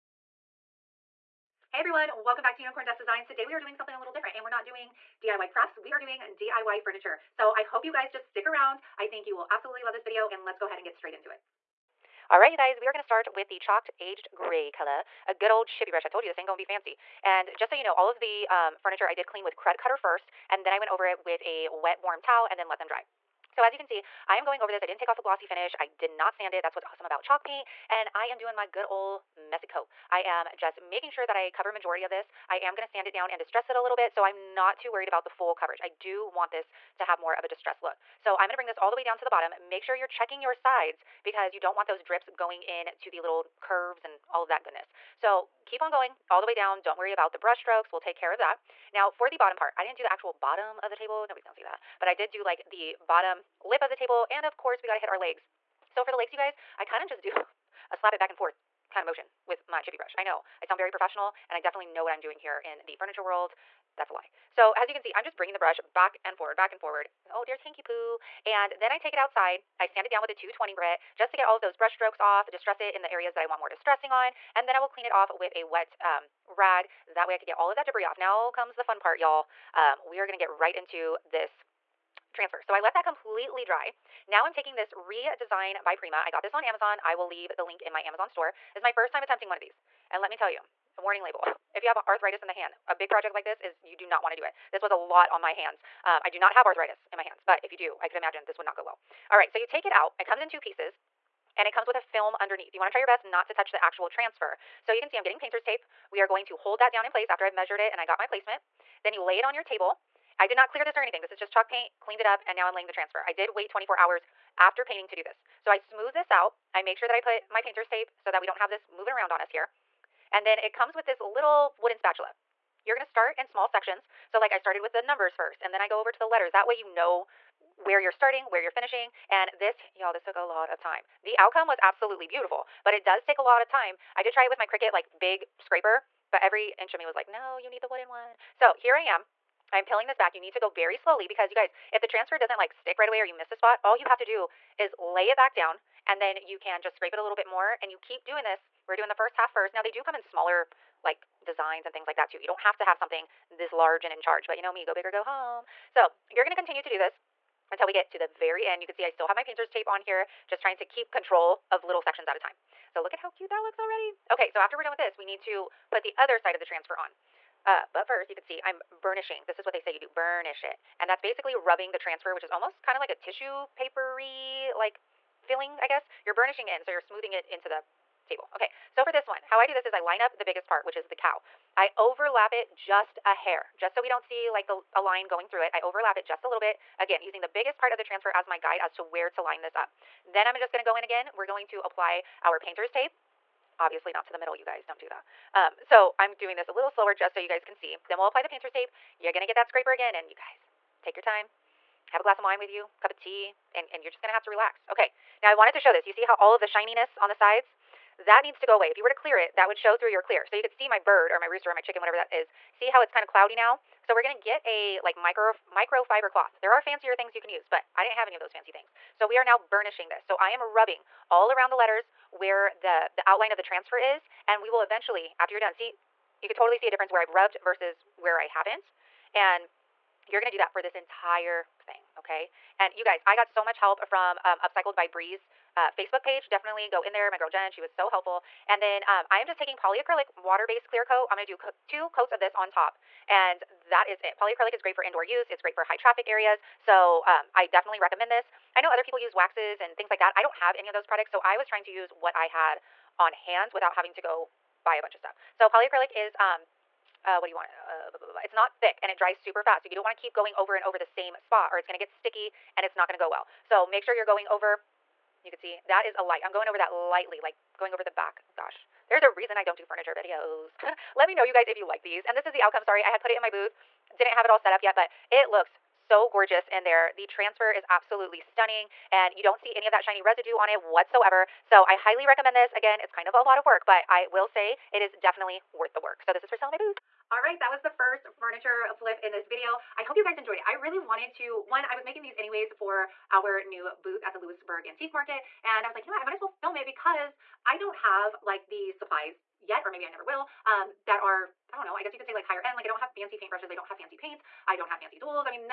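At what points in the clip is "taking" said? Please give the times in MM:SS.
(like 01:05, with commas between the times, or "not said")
01:24, 03:59.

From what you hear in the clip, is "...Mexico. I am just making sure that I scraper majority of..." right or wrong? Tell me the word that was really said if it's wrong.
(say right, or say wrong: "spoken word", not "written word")
wrong: "cover", not "scraper".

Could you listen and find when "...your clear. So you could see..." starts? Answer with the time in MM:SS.
03:30.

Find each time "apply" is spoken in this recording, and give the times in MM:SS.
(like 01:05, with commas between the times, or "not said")
03:11, 03:18.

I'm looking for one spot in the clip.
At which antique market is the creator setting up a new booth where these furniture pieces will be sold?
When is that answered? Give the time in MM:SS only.
04:54.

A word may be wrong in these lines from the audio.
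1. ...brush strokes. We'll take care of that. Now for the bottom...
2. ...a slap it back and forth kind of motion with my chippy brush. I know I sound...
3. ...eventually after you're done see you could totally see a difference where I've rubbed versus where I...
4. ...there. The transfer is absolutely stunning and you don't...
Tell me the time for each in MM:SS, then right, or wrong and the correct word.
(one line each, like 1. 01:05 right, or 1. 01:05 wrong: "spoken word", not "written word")
1. 00:47 right
2. 00:57 right
3. 03:44 right
4. 04:36 right.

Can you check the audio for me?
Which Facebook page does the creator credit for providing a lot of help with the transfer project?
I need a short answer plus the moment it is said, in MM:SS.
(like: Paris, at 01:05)
Upcycled by Breeze, at 03:54.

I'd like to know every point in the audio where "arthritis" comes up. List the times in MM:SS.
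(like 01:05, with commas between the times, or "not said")
01:32, 01:36.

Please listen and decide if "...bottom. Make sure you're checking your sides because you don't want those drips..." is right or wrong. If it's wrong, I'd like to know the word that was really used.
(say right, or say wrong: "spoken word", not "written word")
right.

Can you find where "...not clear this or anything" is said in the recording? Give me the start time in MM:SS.
01:50.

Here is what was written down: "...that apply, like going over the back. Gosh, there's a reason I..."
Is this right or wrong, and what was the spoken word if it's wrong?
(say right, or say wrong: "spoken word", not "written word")
wrong: "lightly", not "apply".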